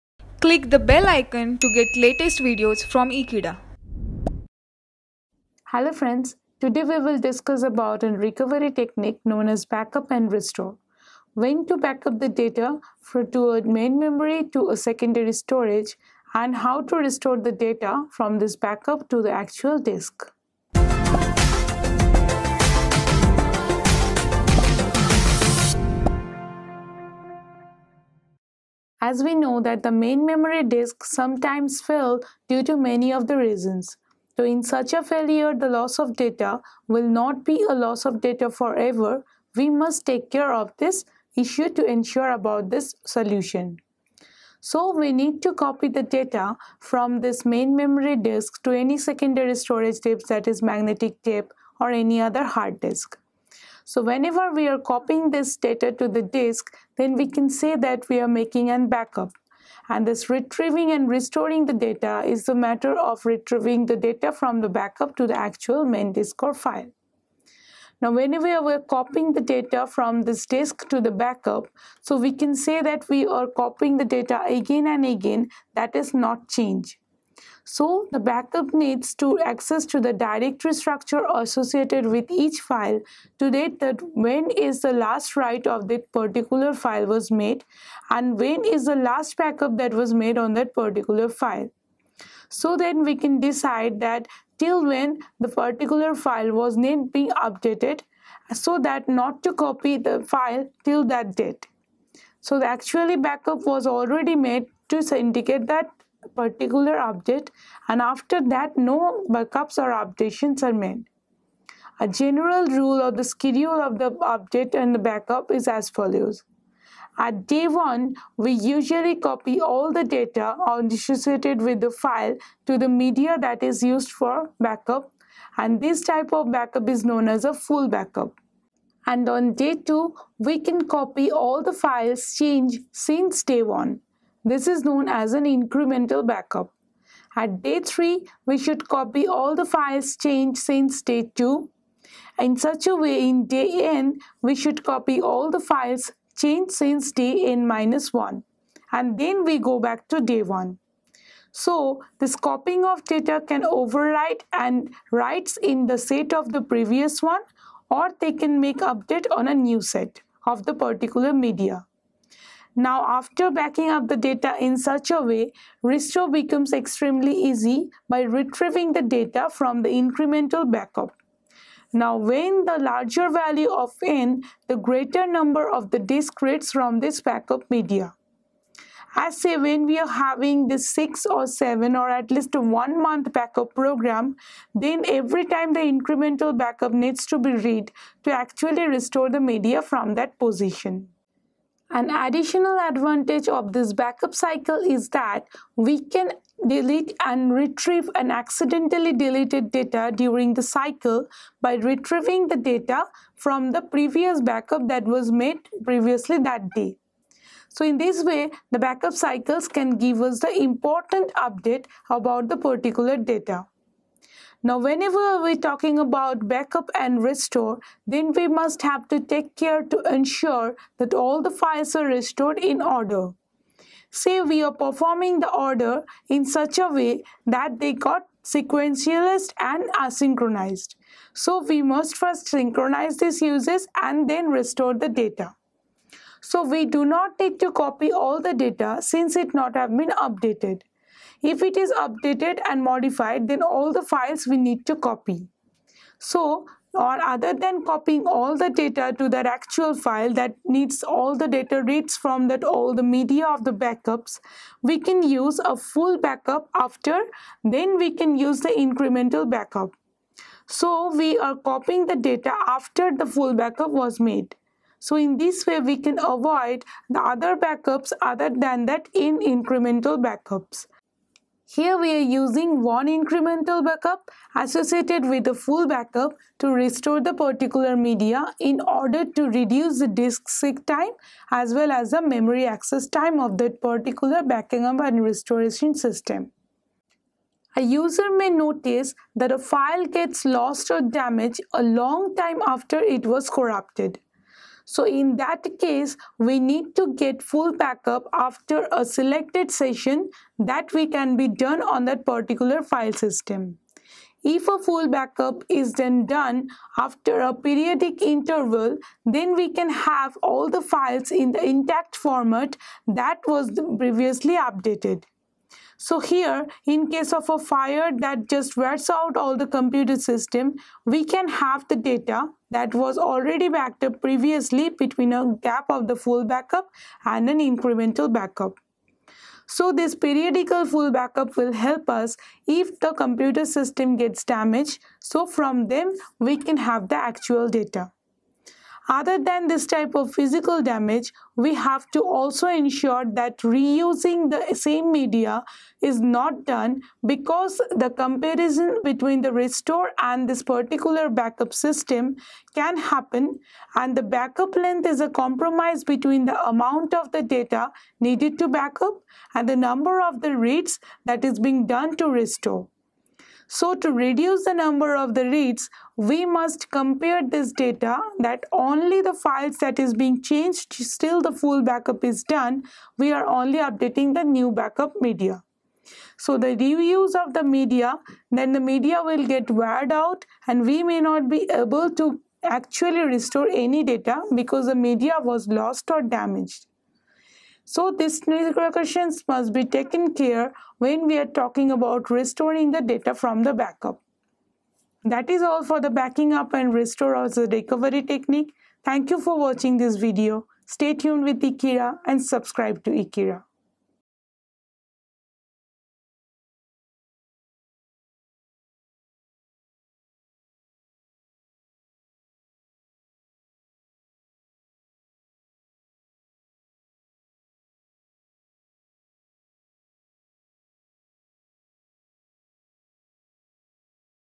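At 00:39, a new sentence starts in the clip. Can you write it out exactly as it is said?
We must take care of this issue to ensure about this solution.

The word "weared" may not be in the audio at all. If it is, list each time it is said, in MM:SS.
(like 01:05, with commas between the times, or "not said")
06:19.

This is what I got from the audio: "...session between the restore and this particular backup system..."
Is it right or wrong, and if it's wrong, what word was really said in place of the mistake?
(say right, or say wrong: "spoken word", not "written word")
wrong: "comparison", not "session".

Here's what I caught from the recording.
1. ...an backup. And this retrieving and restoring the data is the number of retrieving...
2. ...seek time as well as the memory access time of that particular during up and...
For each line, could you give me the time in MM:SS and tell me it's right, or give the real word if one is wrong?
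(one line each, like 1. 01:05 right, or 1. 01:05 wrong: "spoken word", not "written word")
1. 00:58 wrong: "matter", not "number"
2. 04:40 wrong: "backing", not "during".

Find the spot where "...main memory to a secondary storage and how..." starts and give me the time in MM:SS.
00:13.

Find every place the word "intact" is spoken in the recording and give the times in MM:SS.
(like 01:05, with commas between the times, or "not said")
05:11.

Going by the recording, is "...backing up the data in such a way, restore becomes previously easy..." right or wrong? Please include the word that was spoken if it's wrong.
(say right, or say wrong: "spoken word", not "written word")
wrong: "extremely", not "previously".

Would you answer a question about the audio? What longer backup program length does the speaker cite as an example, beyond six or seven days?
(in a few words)
one month.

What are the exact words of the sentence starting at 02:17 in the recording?
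At day 3, we should copy all the files changed since day 2.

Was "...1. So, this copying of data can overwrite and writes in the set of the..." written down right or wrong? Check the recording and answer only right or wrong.
right.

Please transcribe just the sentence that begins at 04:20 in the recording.
So we are copying the data after the full backup was made.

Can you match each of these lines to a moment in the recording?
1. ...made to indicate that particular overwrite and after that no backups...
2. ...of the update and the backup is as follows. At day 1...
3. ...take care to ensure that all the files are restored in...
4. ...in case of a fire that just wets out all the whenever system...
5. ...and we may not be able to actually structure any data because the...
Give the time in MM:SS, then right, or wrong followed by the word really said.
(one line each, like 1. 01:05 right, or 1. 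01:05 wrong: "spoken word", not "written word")
1. 01:44 wrong: "update", not "overwrite"
2. 01:53 right
3. 03:39 right
4. 05:16 wrong: "computer", not "whenever"
5. 06:20 wrong: "restore", not "structure".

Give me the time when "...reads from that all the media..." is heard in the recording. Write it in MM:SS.
04:11.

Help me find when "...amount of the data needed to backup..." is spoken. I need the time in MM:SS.
05:56.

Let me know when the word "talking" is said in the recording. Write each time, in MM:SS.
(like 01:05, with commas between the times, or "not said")
03:35, 06:31.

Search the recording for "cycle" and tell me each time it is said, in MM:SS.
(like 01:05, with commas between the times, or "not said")
03:14, 03:20, 03:29.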